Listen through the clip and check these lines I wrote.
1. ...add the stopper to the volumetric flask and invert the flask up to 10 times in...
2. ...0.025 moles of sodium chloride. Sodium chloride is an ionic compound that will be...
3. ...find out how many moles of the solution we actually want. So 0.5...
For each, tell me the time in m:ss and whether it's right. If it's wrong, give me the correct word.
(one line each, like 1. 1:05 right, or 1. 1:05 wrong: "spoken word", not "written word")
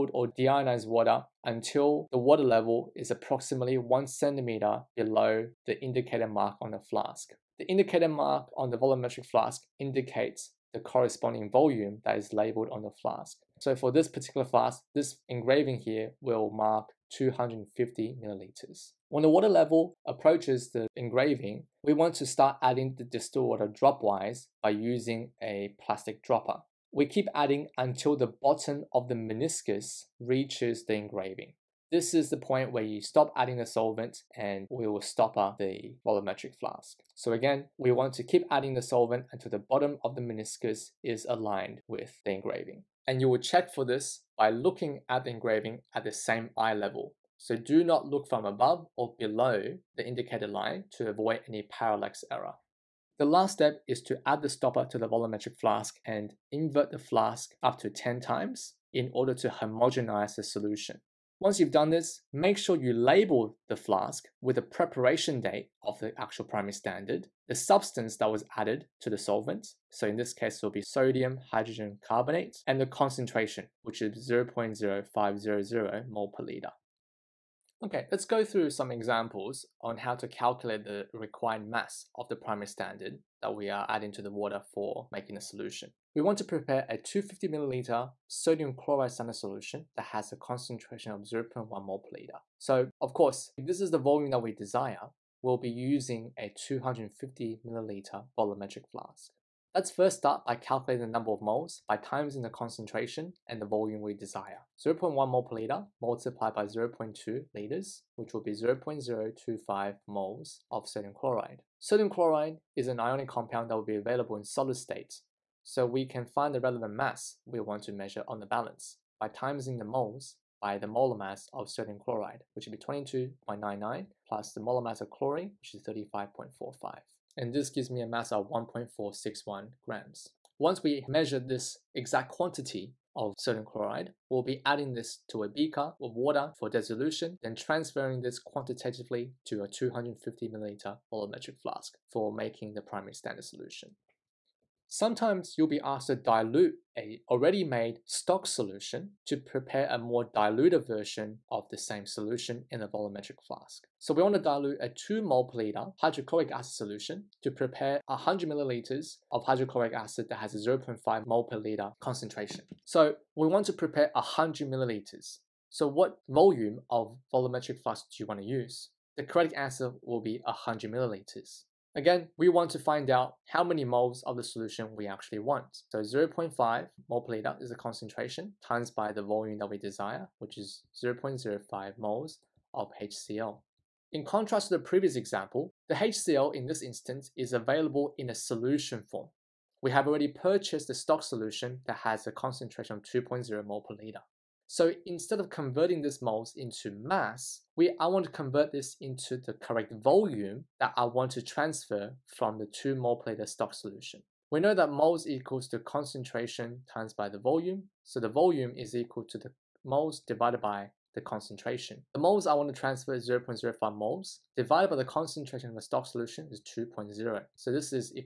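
1. 0:54 right
2. 1:48 right
3. 2:52 right.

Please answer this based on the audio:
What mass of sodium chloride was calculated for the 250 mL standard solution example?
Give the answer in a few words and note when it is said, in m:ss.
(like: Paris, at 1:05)
1.461 grams, at 2:08.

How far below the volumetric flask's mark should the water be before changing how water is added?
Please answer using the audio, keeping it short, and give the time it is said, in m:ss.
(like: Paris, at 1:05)
1 centimeter, at 0:03.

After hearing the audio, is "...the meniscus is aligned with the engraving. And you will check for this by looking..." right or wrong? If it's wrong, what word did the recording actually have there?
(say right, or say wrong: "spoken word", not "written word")
right.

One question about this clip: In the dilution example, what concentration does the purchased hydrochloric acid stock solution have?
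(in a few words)
2.0 mol/L.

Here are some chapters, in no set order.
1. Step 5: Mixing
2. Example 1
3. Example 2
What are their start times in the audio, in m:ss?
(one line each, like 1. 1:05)
1. 0:52
2. 1:17
3. 2:24.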